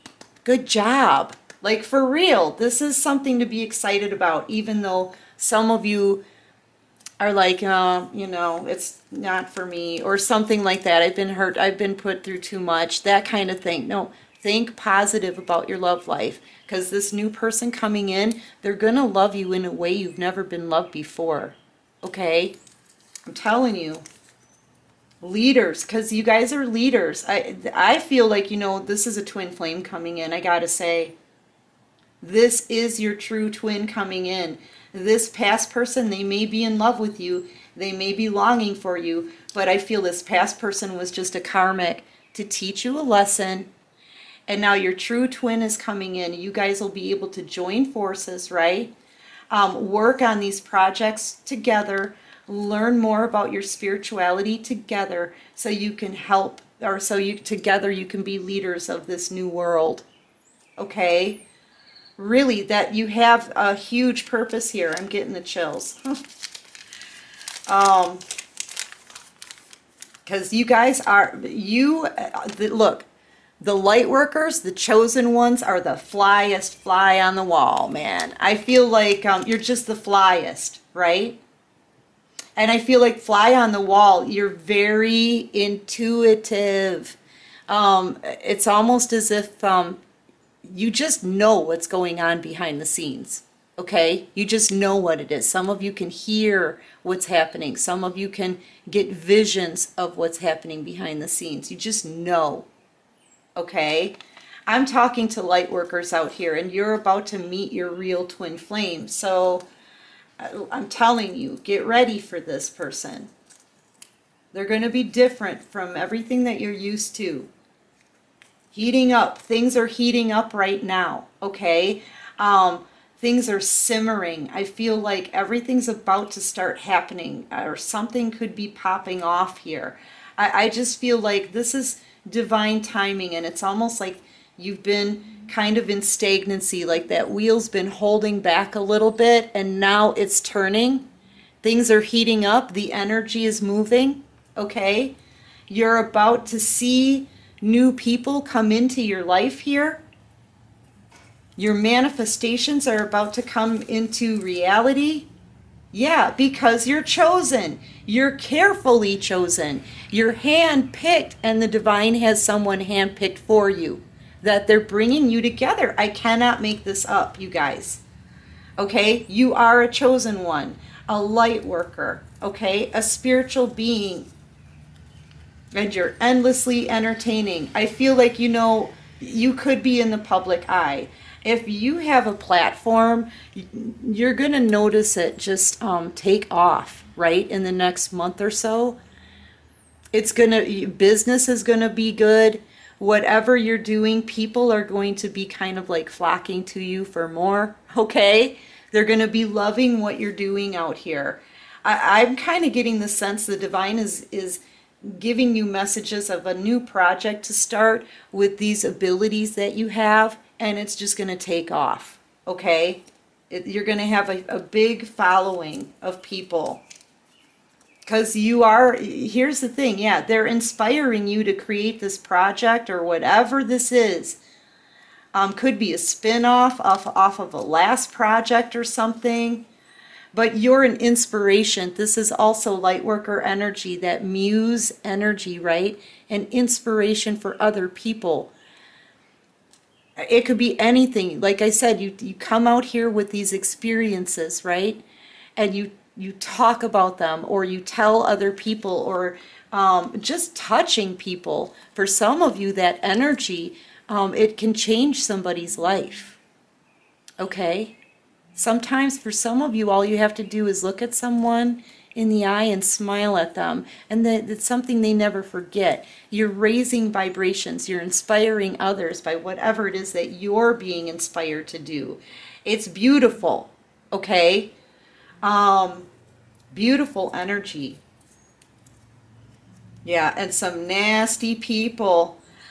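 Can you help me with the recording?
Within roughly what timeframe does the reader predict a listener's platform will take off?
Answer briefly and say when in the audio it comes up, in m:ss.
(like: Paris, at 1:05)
the next month, at 3:07.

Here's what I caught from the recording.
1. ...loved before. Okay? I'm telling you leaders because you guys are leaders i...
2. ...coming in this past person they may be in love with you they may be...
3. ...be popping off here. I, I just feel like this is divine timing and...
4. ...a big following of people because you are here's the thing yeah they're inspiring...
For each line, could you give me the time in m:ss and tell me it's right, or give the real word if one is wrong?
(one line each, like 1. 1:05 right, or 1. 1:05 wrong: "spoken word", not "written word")
1. 0:20 right
2. 0:33 right
3. 2:08 right
4. 3:34 right.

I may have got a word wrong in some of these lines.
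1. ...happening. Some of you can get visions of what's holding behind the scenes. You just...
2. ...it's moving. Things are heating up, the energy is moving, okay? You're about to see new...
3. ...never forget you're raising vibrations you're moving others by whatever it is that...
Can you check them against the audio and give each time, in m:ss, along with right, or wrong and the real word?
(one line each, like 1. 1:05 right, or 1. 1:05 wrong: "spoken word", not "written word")
1. 1:37 wrong: "happening", not "holding"
2. 2:20 wrong: "turning", not "moving"
3. 4:25 wrong: "inspiring", not "moving".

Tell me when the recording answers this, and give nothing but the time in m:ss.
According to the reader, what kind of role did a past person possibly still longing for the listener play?
0:41.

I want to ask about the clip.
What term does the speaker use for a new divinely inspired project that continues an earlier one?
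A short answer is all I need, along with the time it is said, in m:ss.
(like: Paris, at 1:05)
spin-off, at 3:45.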